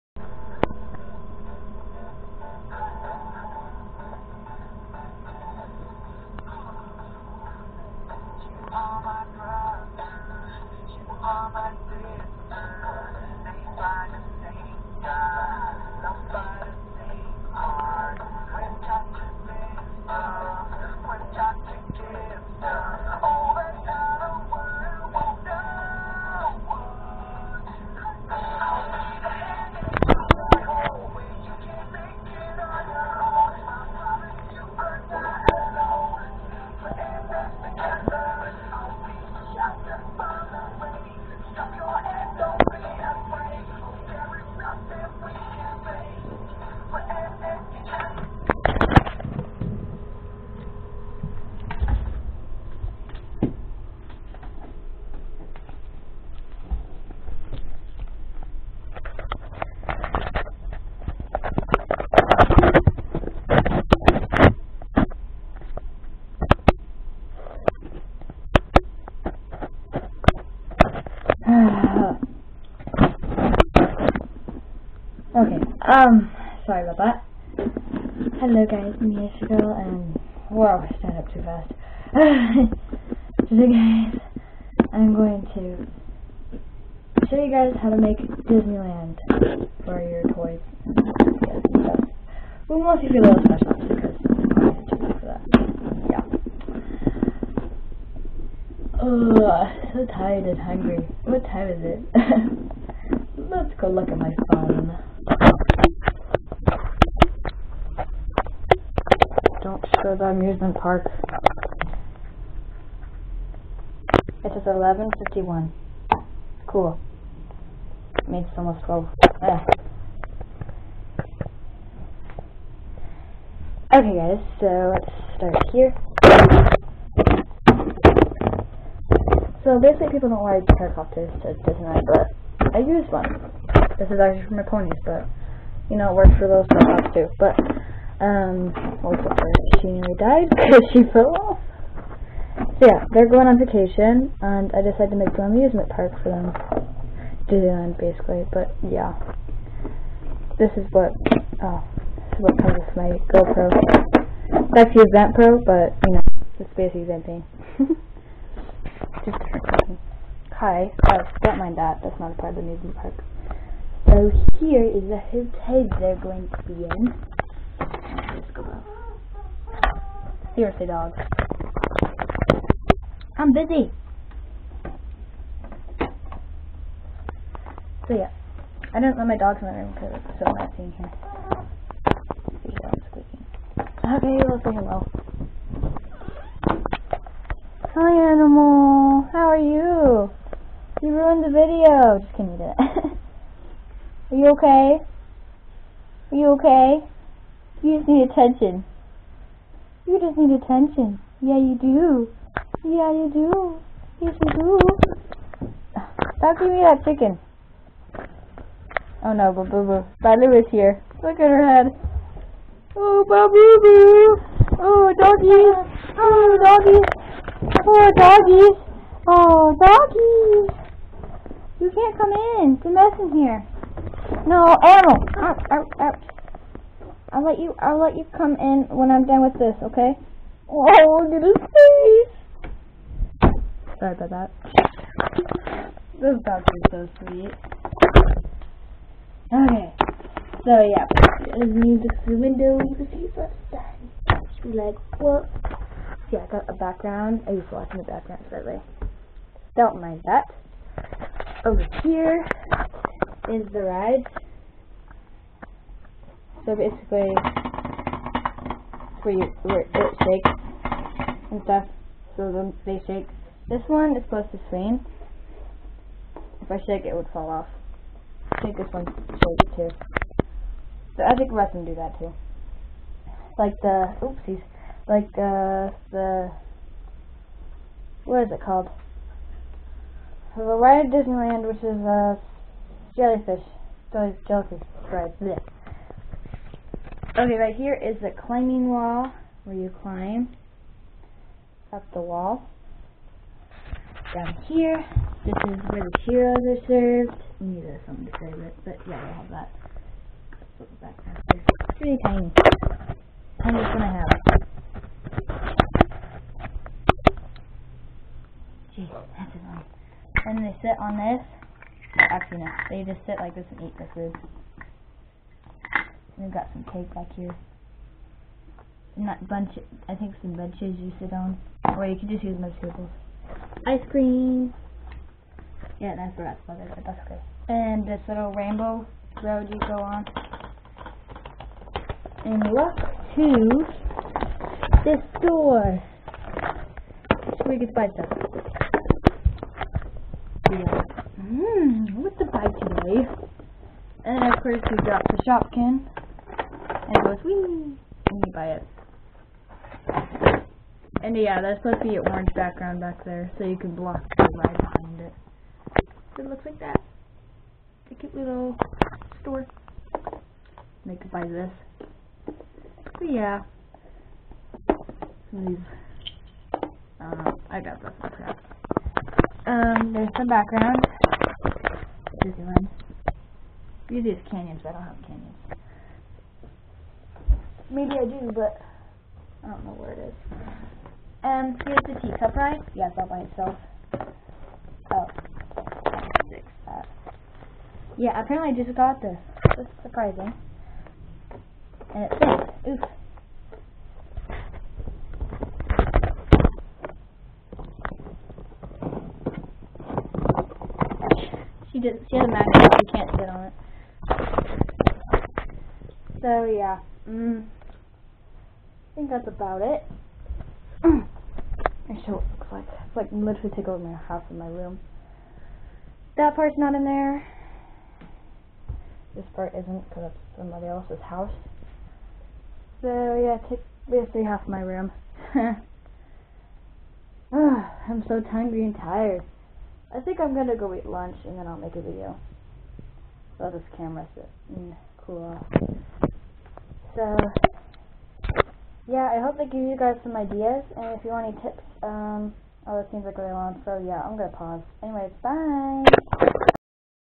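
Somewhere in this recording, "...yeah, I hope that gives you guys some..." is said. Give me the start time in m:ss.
7:19.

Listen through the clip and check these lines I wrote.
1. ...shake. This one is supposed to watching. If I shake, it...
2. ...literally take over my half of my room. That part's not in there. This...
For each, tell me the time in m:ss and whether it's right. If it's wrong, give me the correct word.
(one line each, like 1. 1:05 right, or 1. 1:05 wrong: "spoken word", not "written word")
1. 4:23 wrong: "swing", not "watching"
2. 6:53 right.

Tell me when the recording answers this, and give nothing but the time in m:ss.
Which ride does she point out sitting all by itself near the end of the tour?
6:22.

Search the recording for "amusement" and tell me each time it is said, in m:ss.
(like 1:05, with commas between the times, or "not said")
1:50, 2:25, 2:42.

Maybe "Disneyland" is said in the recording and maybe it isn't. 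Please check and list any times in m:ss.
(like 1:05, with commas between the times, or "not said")
1:28, 2:27, 4:41, 6:12.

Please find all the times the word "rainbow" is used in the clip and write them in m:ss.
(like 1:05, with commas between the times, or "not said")
5:28.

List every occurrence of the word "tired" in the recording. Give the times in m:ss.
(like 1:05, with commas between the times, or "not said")
1:40, 7:08.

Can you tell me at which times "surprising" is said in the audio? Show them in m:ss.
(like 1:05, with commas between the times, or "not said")
6:30.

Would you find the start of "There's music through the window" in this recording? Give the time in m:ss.
4:01.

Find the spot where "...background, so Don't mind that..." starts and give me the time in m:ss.
4:08.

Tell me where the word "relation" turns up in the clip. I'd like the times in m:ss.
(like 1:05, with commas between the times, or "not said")
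not said.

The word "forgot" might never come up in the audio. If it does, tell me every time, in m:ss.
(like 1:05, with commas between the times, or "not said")
5:26.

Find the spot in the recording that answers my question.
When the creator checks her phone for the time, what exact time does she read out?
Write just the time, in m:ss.
1:54.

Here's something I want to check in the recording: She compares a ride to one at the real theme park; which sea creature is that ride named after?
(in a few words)
jellyfish.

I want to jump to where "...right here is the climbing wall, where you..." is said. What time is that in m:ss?
4:47.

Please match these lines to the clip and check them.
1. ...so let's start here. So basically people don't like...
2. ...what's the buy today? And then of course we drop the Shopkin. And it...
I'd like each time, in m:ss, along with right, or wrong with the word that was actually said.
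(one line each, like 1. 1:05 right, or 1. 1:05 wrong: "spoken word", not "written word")
1. 2:04 right
2. 5:42 right.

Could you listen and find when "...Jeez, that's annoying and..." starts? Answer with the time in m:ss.
5:08.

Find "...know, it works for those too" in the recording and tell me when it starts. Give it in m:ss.
2:15.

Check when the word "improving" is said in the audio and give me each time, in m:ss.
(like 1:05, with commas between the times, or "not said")
not said.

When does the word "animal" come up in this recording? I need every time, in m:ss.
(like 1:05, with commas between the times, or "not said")
3:08, 3:44.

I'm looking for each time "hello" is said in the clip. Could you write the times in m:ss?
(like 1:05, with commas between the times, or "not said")
1:18, 3:04.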